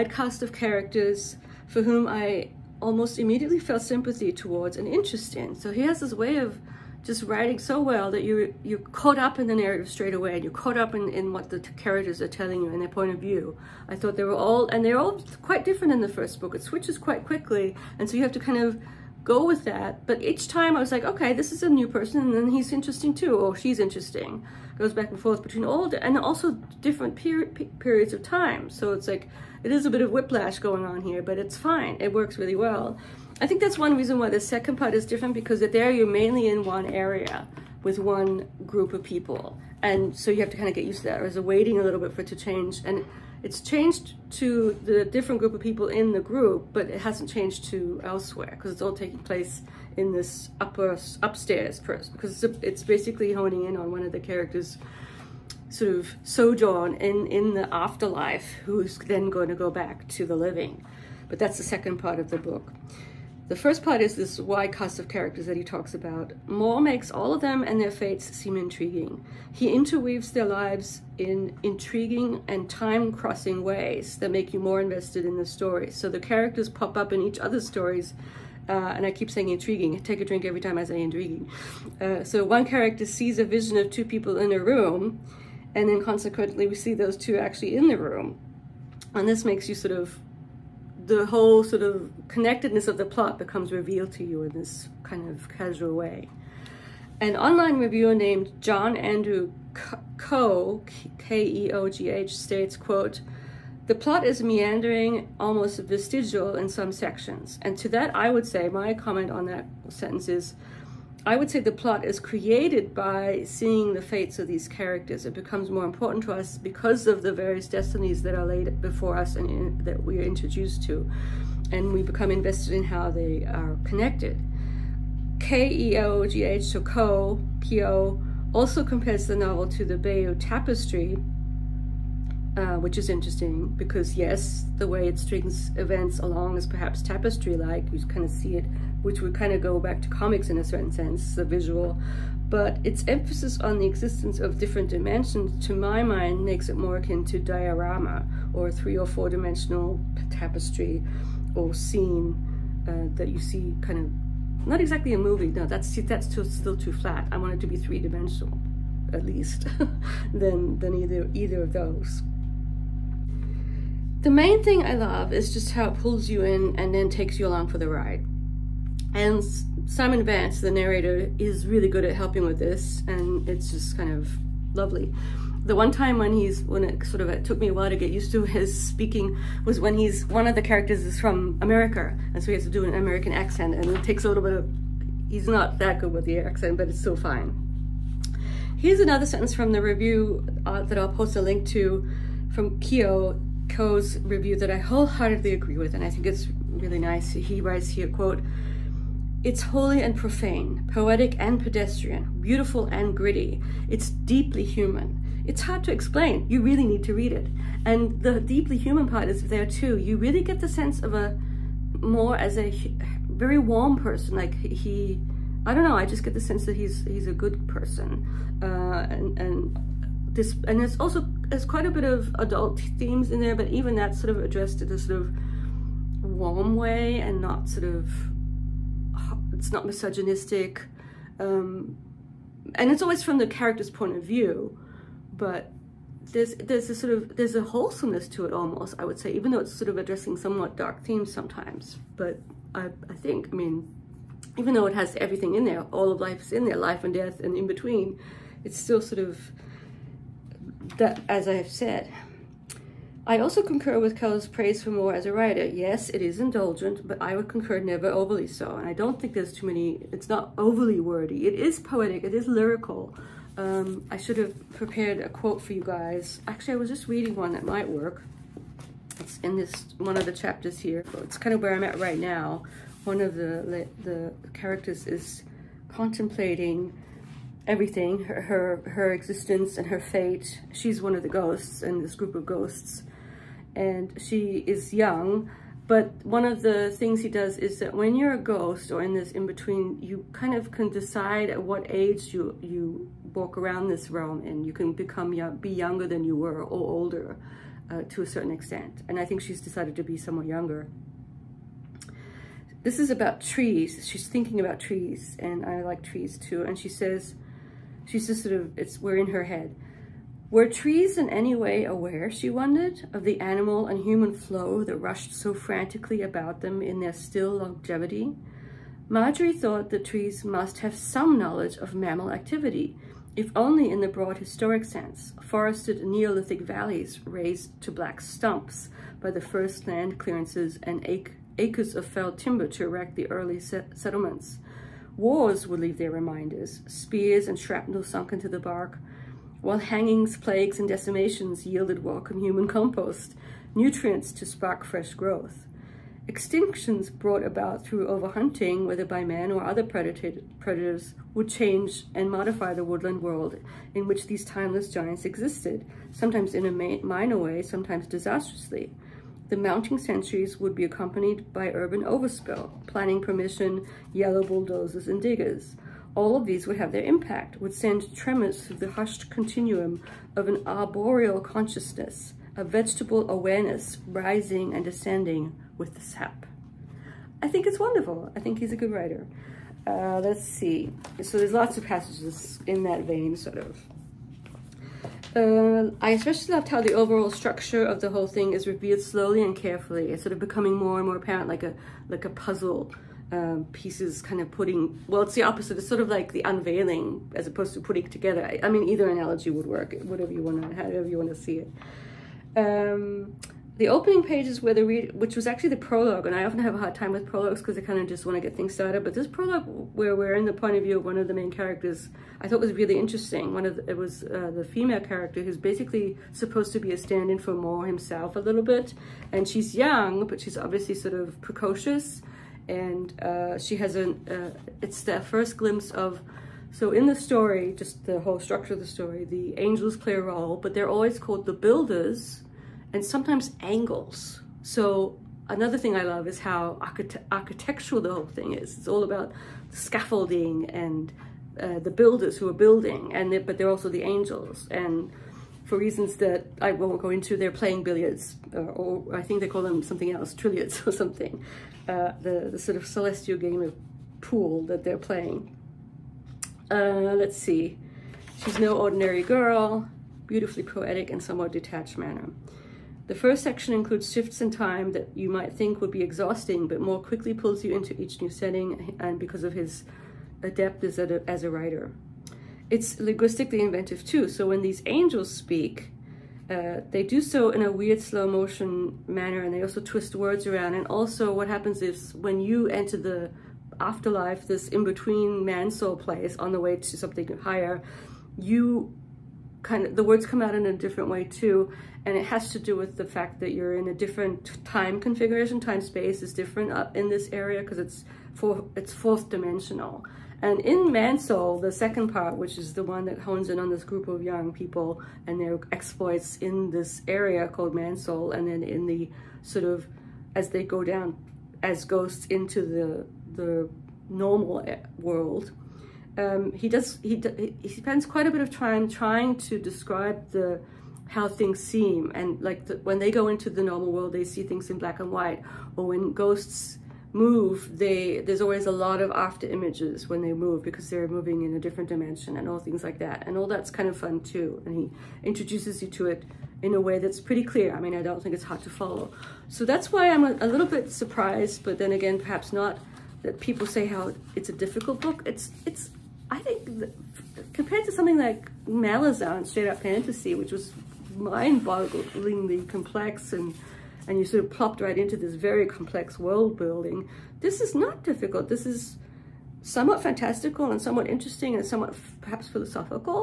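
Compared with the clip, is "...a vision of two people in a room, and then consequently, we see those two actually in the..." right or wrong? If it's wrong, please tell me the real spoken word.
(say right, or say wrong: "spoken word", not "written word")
right.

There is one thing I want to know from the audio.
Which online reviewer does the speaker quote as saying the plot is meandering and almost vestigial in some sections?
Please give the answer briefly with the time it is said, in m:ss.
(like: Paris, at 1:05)
John Andrew Keogh, at 1:38.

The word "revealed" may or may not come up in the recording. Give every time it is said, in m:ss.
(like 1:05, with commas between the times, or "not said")
1:33, 6:28.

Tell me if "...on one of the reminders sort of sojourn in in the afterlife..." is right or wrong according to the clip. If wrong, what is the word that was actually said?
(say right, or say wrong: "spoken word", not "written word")
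wrong: "characters", not "reminders".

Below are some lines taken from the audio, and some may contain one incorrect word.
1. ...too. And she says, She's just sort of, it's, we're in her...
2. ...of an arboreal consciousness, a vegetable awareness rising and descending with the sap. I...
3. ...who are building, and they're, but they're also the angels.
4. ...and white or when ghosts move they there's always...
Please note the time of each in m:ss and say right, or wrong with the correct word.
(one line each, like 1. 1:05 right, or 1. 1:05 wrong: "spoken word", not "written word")
1. 5:06 right
2. 6:10 right
3. 7:22 right
4. 8:44 right.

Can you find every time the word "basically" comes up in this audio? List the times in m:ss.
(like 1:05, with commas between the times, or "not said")
0:52, 6:55.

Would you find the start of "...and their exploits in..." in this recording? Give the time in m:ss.
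8:25.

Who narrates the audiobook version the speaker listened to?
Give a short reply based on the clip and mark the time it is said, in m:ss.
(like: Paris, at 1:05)
Simon Vance, at 2:49.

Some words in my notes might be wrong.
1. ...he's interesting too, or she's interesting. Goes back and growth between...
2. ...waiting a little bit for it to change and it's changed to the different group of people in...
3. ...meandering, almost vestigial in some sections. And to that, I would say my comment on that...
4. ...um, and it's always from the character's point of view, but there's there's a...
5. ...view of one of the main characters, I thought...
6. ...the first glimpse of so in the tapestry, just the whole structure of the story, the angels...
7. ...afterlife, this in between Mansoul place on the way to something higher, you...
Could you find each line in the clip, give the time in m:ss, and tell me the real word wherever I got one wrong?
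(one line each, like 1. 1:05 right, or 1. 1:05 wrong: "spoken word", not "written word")
1. 0:22 wrong: "forth", not "growth"
2. 0:41 right
3. 1:44 right
4. 3:51 right
5. 6:50 right
6. 7:05 wrong: "story", not "tapestry"
7. 8:03 right.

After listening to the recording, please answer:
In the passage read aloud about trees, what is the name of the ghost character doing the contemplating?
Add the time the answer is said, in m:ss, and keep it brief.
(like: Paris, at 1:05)
Marjorie, at 5:19.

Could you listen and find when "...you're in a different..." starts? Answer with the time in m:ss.
8:13.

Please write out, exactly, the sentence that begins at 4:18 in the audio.
And I don't think there's too many, it's not overly wordy.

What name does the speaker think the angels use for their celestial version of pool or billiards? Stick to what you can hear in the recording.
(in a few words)
Trilliards.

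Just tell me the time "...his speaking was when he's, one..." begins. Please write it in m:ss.
2:58.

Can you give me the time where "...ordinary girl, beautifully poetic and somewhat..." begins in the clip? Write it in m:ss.
7:38.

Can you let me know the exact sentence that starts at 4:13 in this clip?
I also concur with Keller's praise for Moore as a writer.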